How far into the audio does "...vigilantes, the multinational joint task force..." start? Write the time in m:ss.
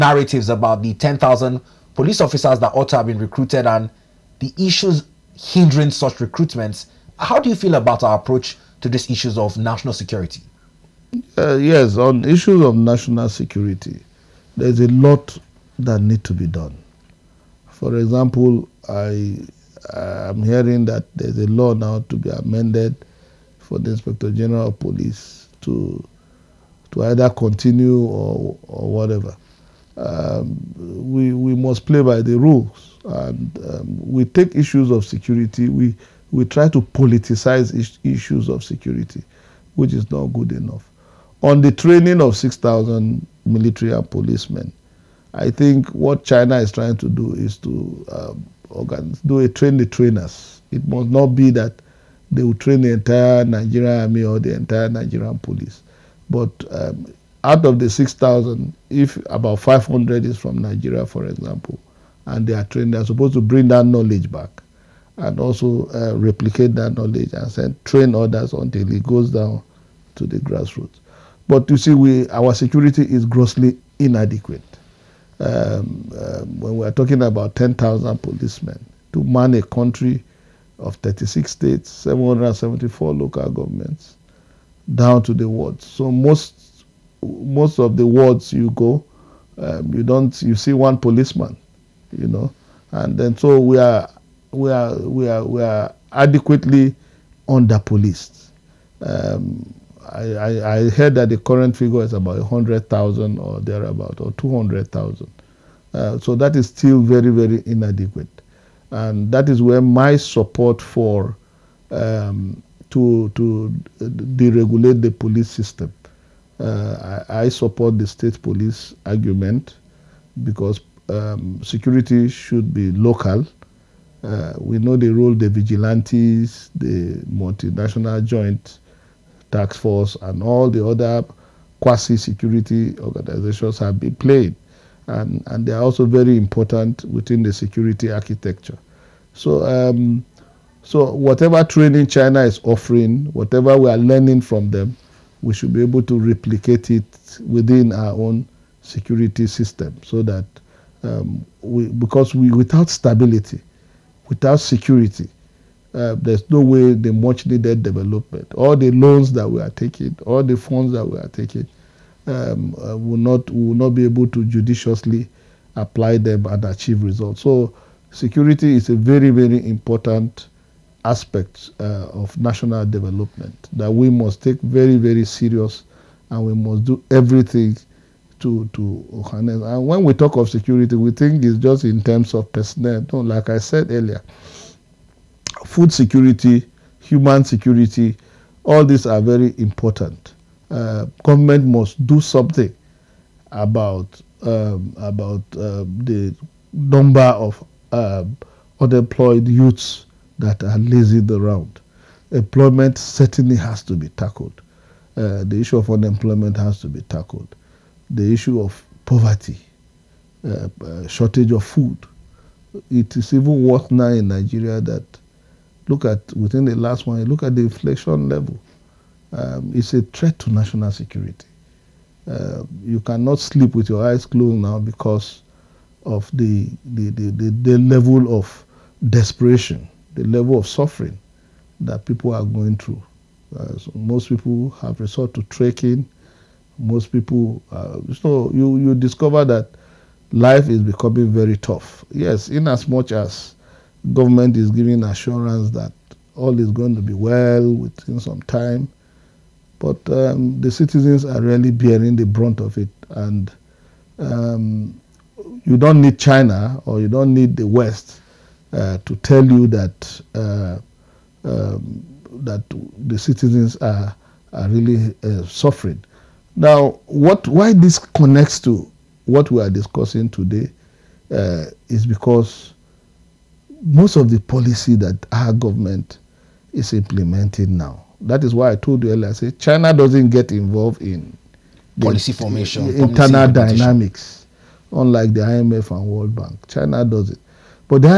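2:05.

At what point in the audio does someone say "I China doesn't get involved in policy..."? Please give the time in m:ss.
4:39.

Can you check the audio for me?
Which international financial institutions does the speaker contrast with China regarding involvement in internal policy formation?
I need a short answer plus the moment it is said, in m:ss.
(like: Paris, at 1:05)
IMF and World Bank, at 4:45.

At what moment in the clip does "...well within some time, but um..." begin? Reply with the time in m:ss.
4:07.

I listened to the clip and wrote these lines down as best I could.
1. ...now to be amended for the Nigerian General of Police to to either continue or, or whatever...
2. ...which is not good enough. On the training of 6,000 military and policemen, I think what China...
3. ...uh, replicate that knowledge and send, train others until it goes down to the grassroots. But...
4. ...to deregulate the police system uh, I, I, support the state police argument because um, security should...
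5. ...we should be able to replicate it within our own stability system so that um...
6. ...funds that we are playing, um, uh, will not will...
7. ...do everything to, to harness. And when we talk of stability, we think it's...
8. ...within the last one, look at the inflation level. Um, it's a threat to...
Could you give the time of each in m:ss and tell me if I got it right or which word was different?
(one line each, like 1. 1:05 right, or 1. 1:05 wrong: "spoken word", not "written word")
1. 0:21 wrong: "Inspector", not "Nigerian"
2. 0:39 right
3. 1:05 right
4. 1:53 right
5. 2:25 wrong: "security", not "stability"
6. 2:40 wrong: "taking", not "playing"
7. 2:56 wrong: "security", not "stability"
8. 3:36 right.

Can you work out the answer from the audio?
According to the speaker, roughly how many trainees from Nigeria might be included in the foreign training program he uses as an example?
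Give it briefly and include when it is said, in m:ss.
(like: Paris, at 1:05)
500, at 0:59.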